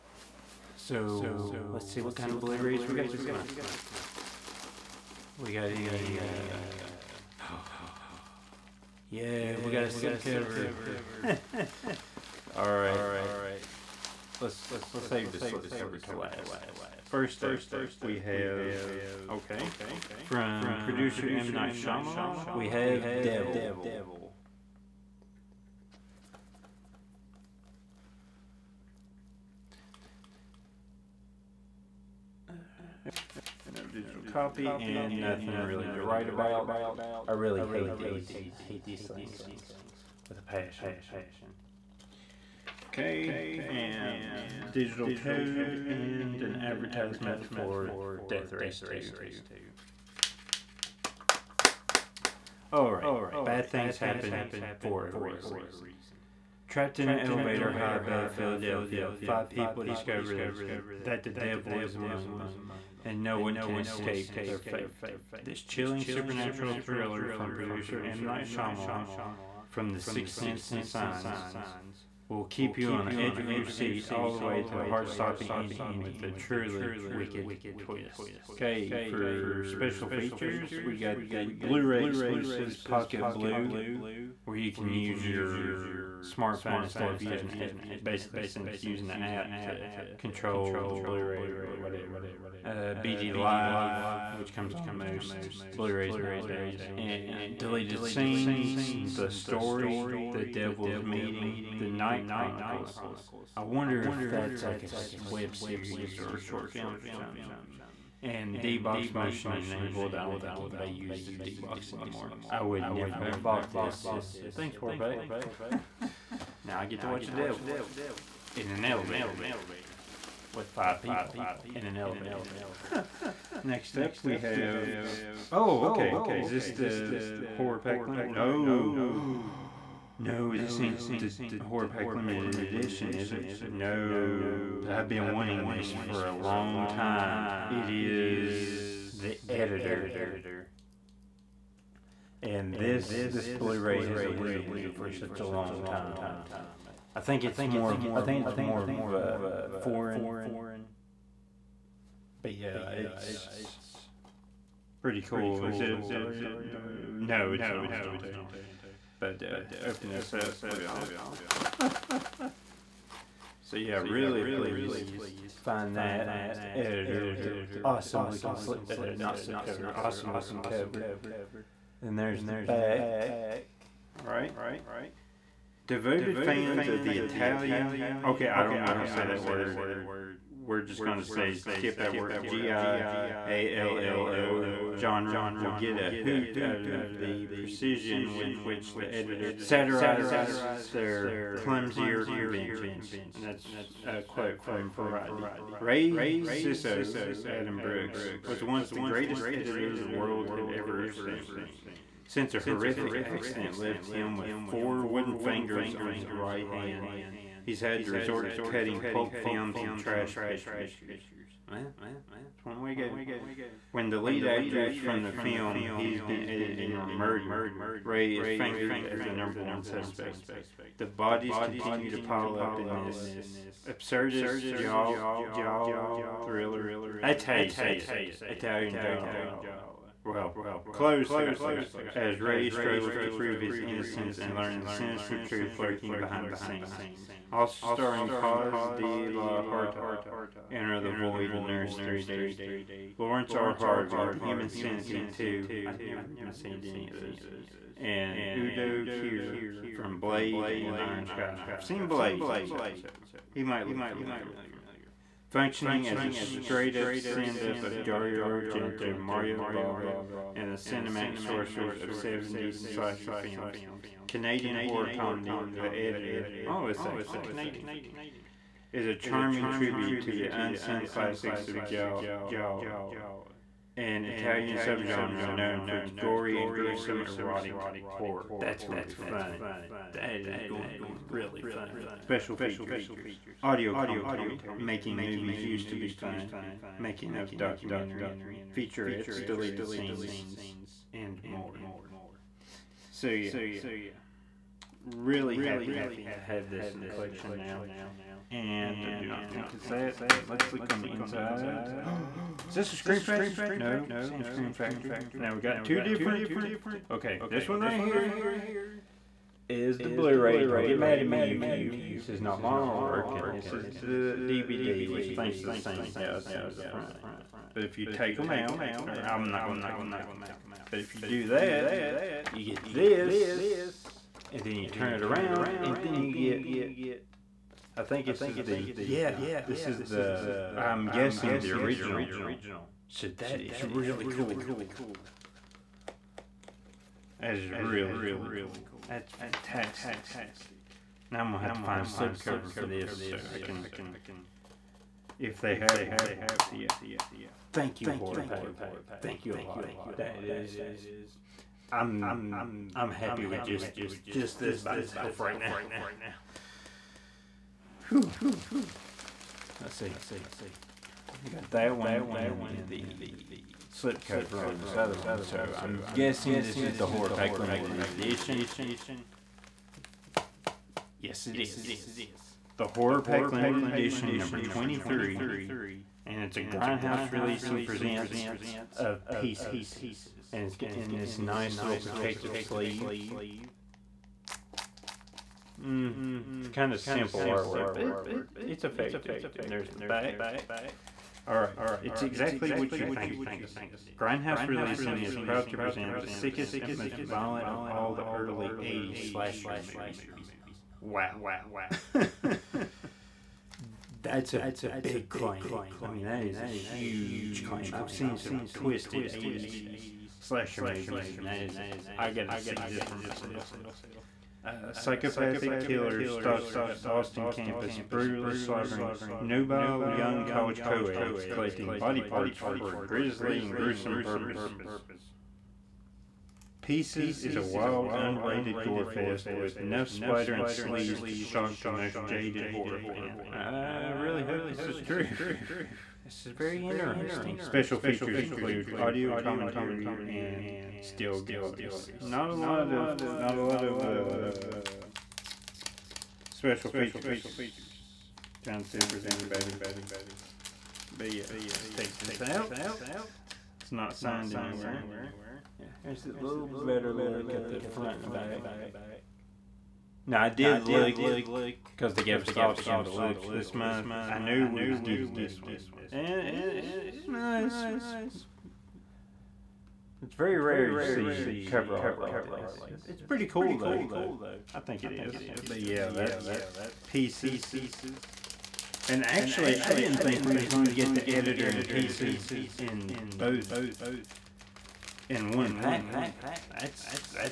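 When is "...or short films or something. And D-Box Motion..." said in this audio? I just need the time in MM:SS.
01:46.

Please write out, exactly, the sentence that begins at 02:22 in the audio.
And this this Blu-ray has eluded me for such a long time.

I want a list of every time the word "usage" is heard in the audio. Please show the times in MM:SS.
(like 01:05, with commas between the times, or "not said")
not said.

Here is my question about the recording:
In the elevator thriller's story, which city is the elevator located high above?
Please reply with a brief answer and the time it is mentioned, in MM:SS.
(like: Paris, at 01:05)
Philadelphia, at 00:58.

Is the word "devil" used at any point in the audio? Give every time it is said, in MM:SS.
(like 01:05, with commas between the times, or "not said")
00:23, 01:01, 01:40, 01:57.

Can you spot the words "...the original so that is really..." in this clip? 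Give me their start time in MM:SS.
05:31.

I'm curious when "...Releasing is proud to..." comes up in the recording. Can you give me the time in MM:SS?
06:34.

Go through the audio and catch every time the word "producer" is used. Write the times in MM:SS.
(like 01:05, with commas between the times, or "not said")
00:20, 01:07.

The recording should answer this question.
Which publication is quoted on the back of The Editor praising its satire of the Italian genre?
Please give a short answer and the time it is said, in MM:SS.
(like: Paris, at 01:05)
Variety, at 03:14.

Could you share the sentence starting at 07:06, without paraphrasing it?
Pieces is a wild, unrated gore fest with enough splatter and sleaze to shock the most jaded horror fan.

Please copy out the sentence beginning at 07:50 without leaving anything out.
It's very rare you see cover art like this.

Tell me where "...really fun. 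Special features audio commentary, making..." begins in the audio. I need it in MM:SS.
04:41.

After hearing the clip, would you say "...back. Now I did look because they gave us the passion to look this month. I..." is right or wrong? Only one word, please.
wrong.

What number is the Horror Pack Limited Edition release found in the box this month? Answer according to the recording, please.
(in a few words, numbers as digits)
23.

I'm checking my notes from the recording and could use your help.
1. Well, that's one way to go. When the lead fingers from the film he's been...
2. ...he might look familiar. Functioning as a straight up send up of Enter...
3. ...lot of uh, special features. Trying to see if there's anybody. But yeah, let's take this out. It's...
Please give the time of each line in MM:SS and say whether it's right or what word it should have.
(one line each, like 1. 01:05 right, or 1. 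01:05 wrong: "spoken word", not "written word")
1. 03:31 wrong: "actors", not "fingers"
2. 04:13 wrong: "Dario", not "Enter"
3. 07:23 right.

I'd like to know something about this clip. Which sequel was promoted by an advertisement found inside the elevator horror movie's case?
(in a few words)
Death Race 2.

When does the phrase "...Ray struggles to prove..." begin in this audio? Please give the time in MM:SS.
03:52.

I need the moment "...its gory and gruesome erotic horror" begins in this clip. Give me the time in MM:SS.
04:35.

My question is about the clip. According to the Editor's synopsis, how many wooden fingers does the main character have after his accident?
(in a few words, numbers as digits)
4.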